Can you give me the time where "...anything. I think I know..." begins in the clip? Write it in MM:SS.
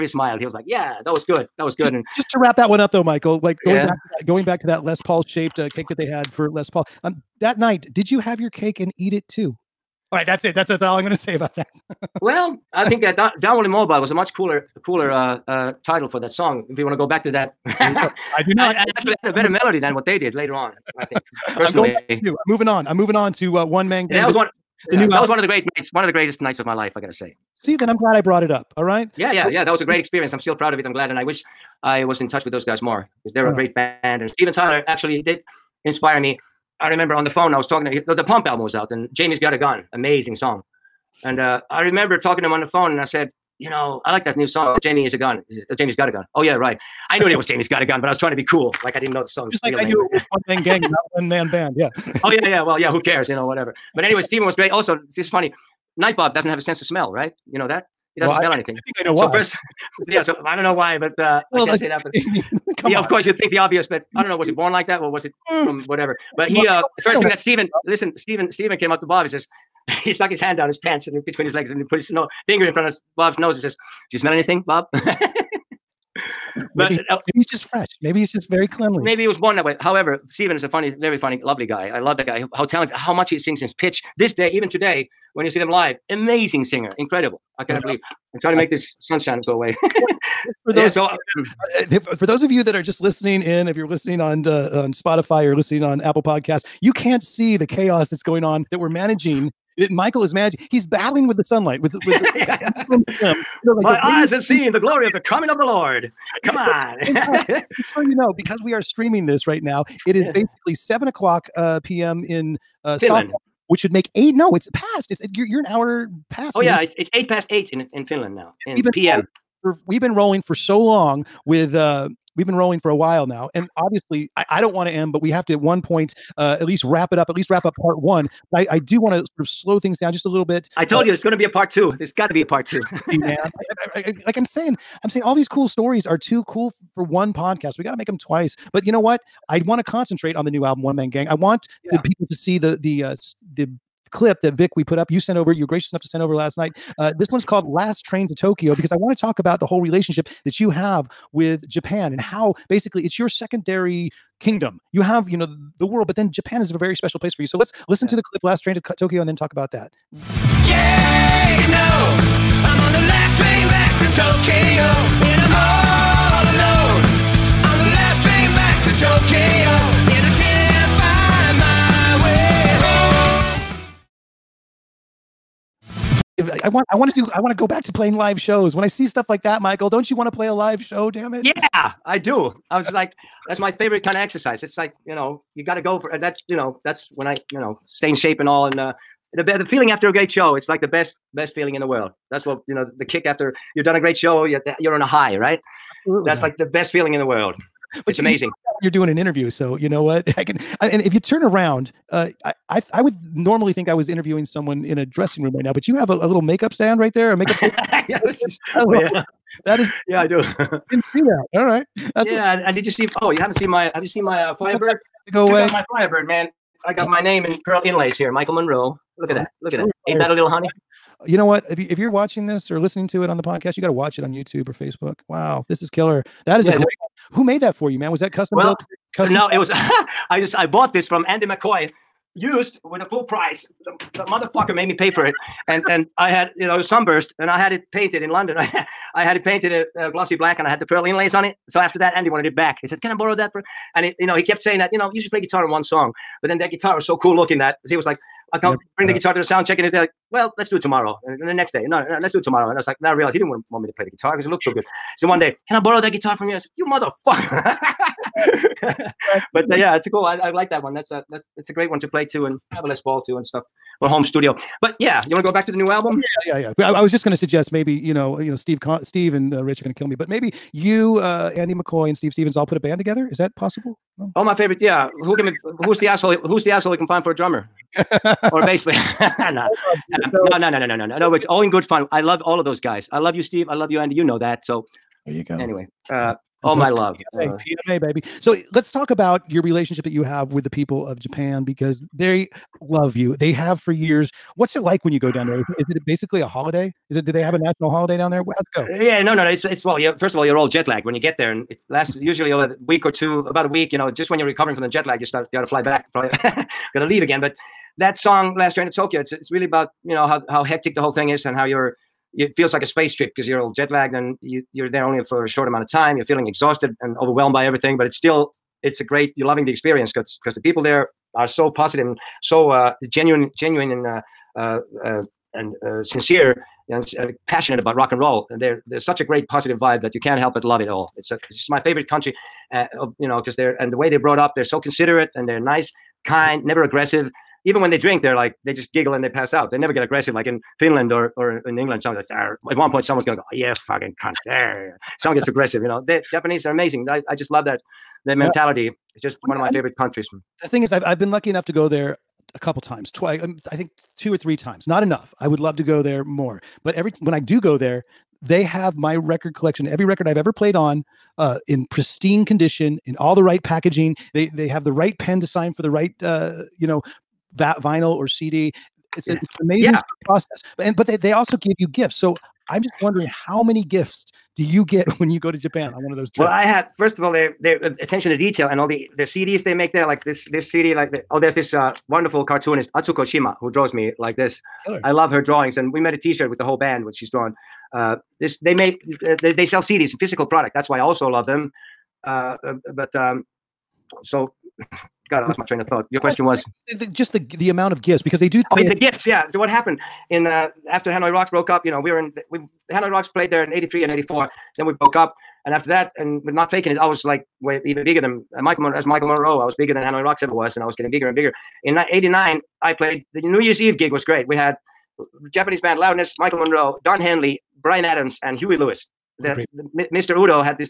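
00:58.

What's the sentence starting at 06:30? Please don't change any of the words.
That's why I also love them.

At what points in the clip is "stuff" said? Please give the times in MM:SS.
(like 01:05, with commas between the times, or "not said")
02:59, 04:23.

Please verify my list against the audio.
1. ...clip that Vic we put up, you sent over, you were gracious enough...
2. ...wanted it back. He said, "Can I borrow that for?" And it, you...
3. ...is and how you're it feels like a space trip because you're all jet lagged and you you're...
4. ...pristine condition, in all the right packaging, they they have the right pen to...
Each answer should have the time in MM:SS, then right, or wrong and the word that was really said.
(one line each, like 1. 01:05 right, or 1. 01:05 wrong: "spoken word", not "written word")
1. 02:24 right
2. 04:02 right
3. 05:11 right
4. 06:01 right.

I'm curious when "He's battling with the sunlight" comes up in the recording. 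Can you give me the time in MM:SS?
01:40.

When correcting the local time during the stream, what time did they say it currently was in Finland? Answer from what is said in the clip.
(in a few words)
Eight past eight.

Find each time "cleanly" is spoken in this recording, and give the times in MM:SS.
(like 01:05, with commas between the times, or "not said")
01:18.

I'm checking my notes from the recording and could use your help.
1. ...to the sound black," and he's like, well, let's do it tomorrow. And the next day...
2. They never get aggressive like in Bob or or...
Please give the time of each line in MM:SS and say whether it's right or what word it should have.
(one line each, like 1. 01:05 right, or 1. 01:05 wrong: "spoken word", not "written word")
1. 04:09 wrong: "check", not "black"
2. 05:39 wrong: "Finland", not "Bob".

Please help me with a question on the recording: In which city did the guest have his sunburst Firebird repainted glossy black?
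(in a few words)
London.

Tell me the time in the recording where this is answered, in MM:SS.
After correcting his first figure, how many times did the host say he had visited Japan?
05:54.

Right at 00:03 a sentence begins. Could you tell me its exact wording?
back, that, going back to that Les Paul shaped uh, cake that they had for Les Paul.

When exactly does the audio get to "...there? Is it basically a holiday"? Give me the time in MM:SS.
04:55.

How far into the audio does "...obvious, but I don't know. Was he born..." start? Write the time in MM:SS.
01:03.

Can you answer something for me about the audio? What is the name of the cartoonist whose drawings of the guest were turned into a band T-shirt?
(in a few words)
Atsuko Shima.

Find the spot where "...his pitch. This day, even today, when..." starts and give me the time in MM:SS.
01:23.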